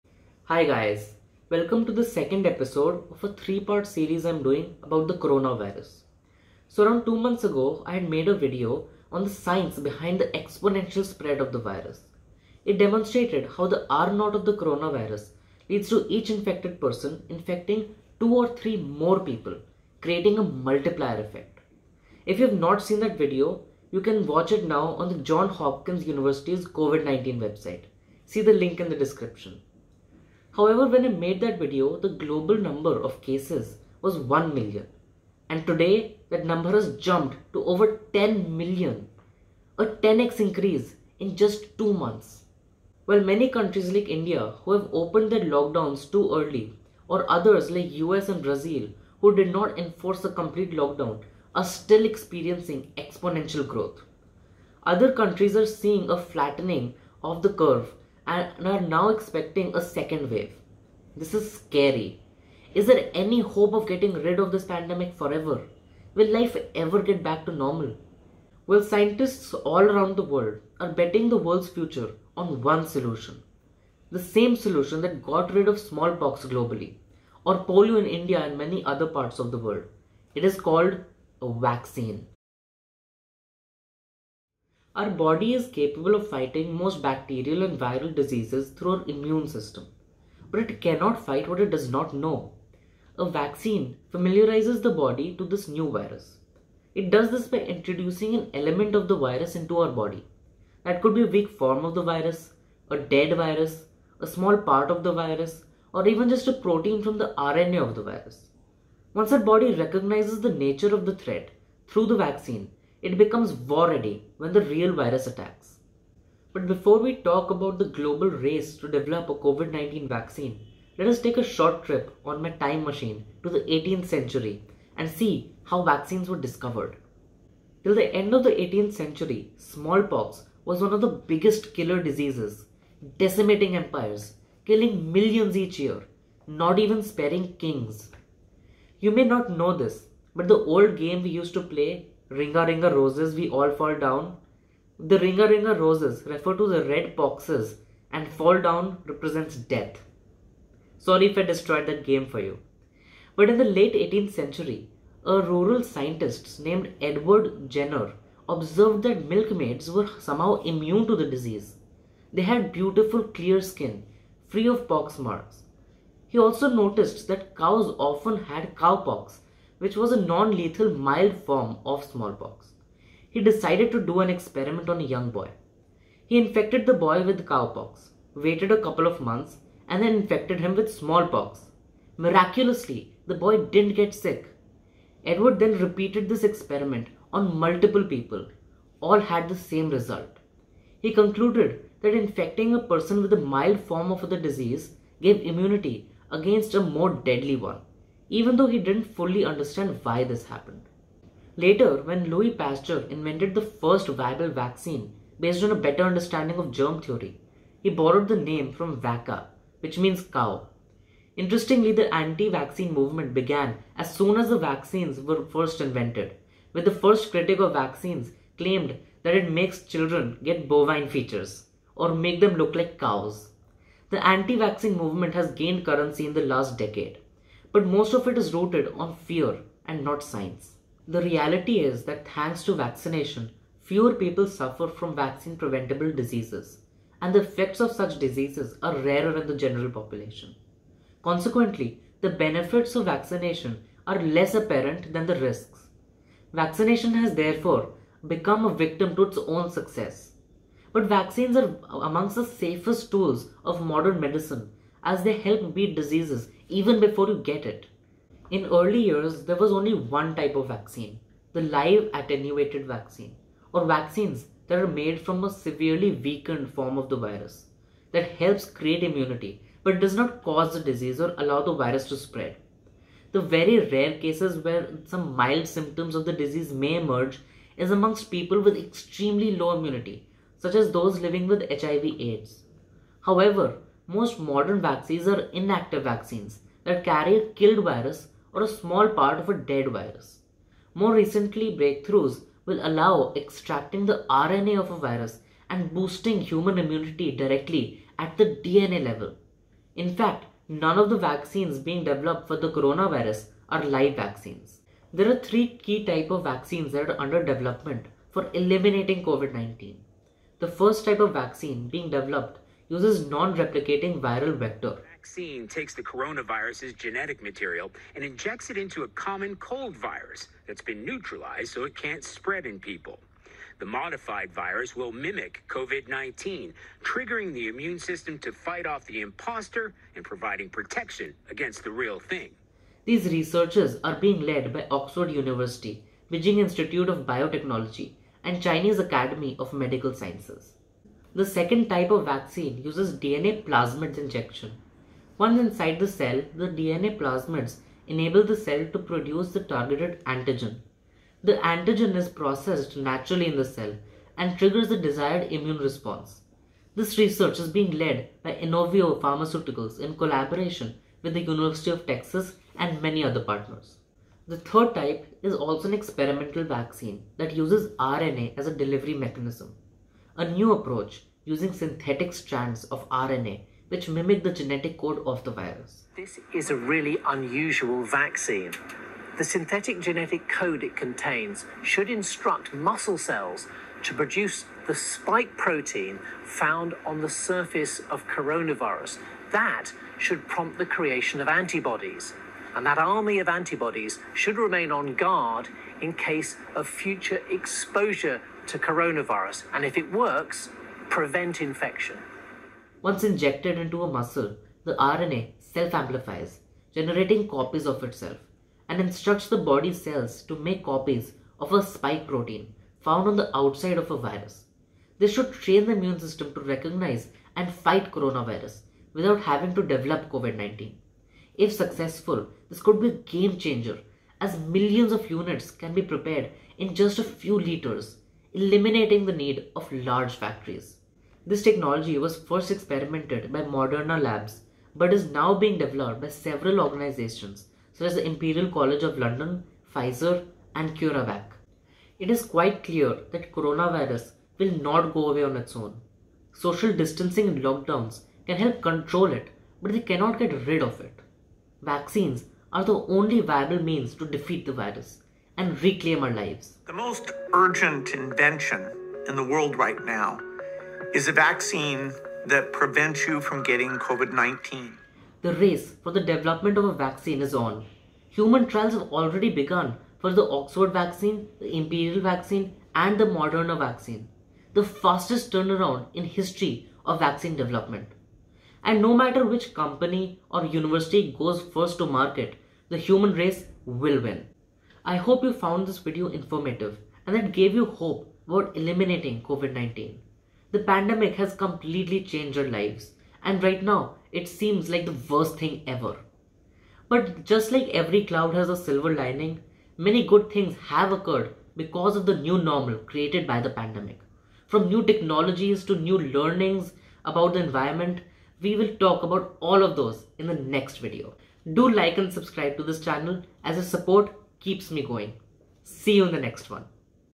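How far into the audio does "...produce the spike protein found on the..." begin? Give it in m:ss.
6:24.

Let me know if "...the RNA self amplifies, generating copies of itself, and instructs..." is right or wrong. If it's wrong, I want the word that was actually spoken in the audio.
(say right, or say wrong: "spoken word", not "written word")
right.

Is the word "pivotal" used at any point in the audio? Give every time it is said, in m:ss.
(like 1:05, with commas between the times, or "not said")
not said.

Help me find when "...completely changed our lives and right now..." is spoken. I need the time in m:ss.
8:11.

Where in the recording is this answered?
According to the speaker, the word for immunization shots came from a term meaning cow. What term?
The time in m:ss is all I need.
3:29.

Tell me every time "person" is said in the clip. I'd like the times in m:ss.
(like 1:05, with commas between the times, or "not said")
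0:16, 3:12.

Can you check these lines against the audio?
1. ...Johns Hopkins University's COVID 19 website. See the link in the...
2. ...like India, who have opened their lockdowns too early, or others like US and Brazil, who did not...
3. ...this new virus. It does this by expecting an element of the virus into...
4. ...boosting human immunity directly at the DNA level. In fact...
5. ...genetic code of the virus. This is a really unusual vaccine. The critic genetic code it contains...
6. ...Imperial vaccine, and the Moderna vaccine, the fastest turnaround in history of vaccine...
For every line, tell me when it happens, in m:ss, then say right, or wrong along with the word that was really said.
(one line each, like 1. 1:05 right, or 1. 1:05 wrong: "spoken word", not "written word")
1. 0:25 right
2. 0:43 right
3. 1:35 wrong: "introducing", not "expecting"
4. 4:55 right
5. 6:14 wrong: "synthetic", not "critic"
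6. 7:51 right.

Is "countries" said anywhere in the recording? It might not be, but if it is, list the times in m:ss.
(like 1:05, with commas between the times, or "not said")
0:43, 0:55.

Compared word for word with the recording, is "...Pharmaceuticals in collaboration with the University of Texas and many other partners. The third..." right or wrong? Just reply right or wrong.
right.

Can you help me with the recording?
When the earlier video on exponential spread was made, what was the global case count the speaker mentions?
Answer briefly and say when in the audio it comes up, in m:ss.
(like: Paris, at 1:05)
1 million, at 0:34.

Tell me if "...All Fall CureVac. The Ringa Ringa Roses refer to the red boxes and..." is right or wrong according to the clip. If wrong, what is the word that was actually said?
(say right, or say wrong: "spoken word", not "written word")
wrong: "Down", not "CureVac".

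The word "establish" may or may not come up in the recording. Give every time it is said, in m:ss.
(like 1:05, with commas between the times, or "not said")
not said.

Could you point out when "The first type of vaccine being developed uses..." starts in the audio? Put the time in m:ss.
5:10.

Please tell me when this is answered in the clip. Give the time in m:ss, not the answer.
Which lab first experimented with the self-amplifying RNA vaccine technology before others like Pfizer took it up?
7:13.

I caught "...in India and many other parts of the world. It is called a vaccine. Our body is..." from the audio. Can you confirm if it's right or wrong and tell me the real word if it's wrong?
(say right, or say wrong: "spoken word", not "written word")
right.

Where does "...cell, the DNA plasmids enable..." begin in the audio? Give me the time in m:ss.
5:46.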